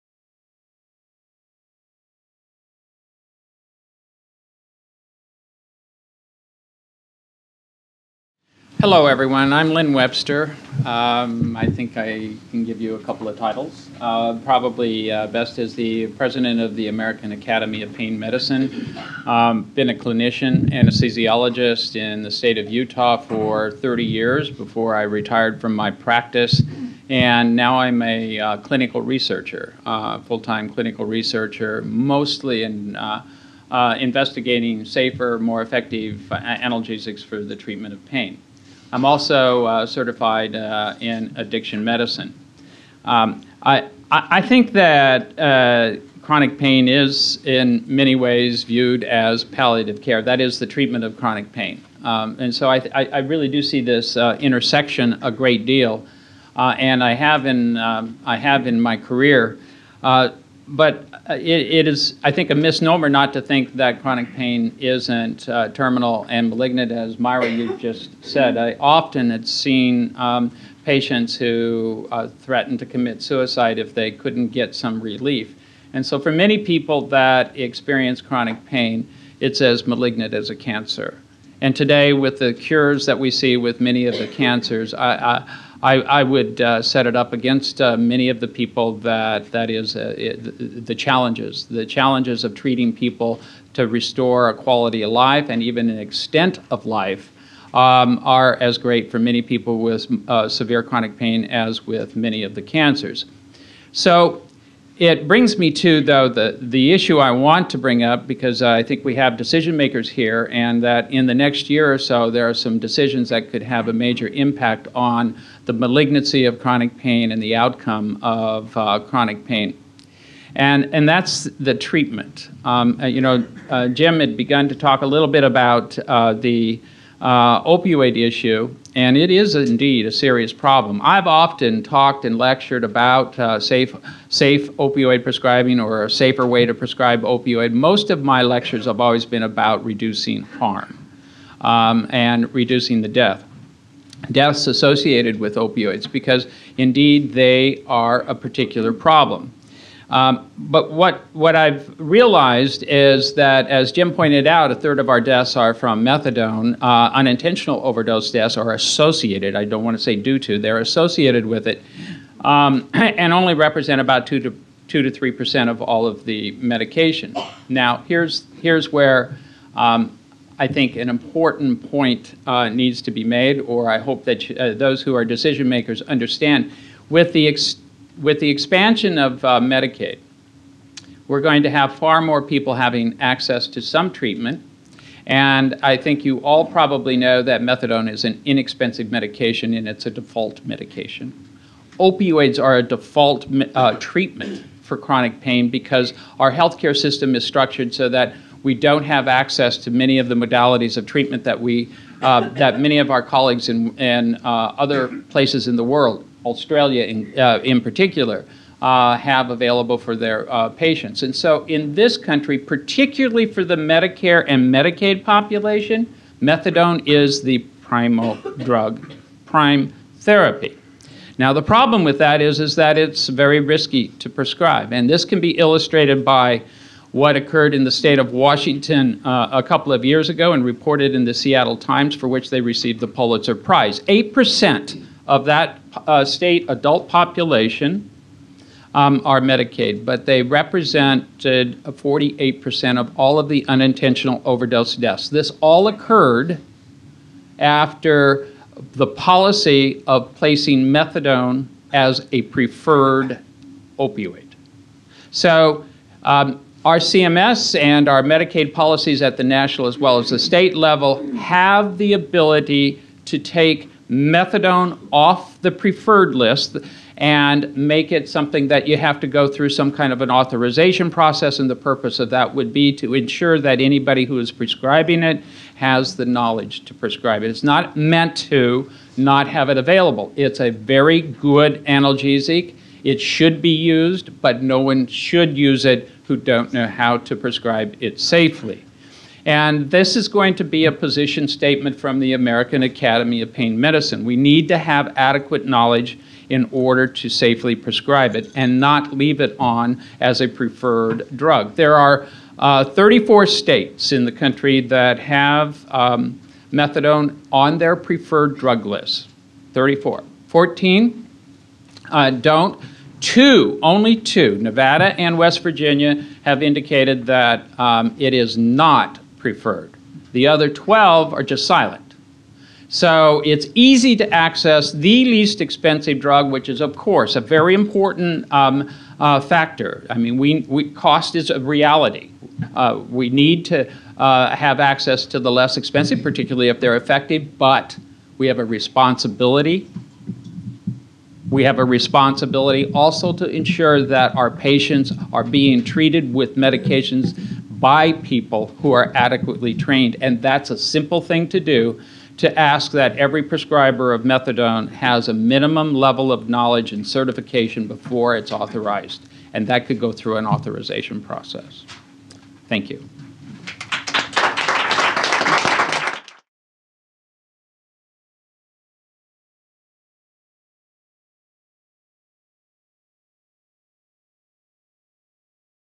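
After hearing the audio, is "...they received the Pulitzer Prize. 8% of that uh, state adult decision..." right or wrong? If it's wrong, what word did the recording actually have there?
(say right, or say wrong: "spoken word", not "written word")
wrong: "population", not "decision".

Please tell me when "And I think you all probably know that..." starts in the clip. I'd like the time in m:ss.
3:05.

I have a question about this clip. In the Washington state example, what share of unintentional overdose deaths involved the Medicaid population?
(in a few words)
48%.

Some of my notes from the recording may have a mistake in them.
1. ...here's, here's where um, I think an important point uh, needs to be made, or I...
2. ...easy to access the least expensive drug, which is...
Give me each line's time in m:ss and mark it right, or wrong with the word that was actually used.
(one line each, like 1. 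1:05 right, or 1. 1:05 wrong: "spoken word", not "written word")
1. 2:48 right
2. 5:23 right.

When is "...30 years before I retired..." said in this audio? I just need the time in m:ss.
0:23.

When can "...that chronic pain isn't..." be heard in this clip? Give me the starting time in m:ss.
1:03.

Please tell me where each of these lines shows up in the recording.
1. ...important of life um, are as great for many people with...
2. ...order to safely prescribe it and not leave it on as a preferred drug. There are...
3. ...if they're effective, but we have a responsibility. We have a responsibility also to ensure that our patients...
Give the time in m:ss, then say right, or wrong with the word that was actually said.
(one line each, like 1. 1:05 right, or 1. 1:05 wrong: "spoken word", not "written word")
1. 1:35 wrong: "extent", not "important"
2. 4:56 right
3. 5:36 right.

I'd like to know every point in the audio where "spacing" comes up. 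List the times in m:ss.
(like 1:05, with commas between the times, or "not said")
not said.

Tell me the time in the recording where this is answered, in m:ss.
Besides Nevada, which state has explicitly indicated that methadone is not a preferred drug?
5:15.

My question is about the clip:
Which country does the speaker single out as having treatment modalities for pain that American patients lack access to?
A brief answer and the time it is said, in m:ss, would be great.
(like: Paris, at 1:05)
Australia, at 3:26.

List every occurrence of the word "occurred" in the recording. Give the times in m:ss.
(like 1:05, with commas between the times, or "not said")
3:47, 4:05.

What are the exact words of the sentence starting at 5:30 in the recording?
I mean, we, we, cost is a reality.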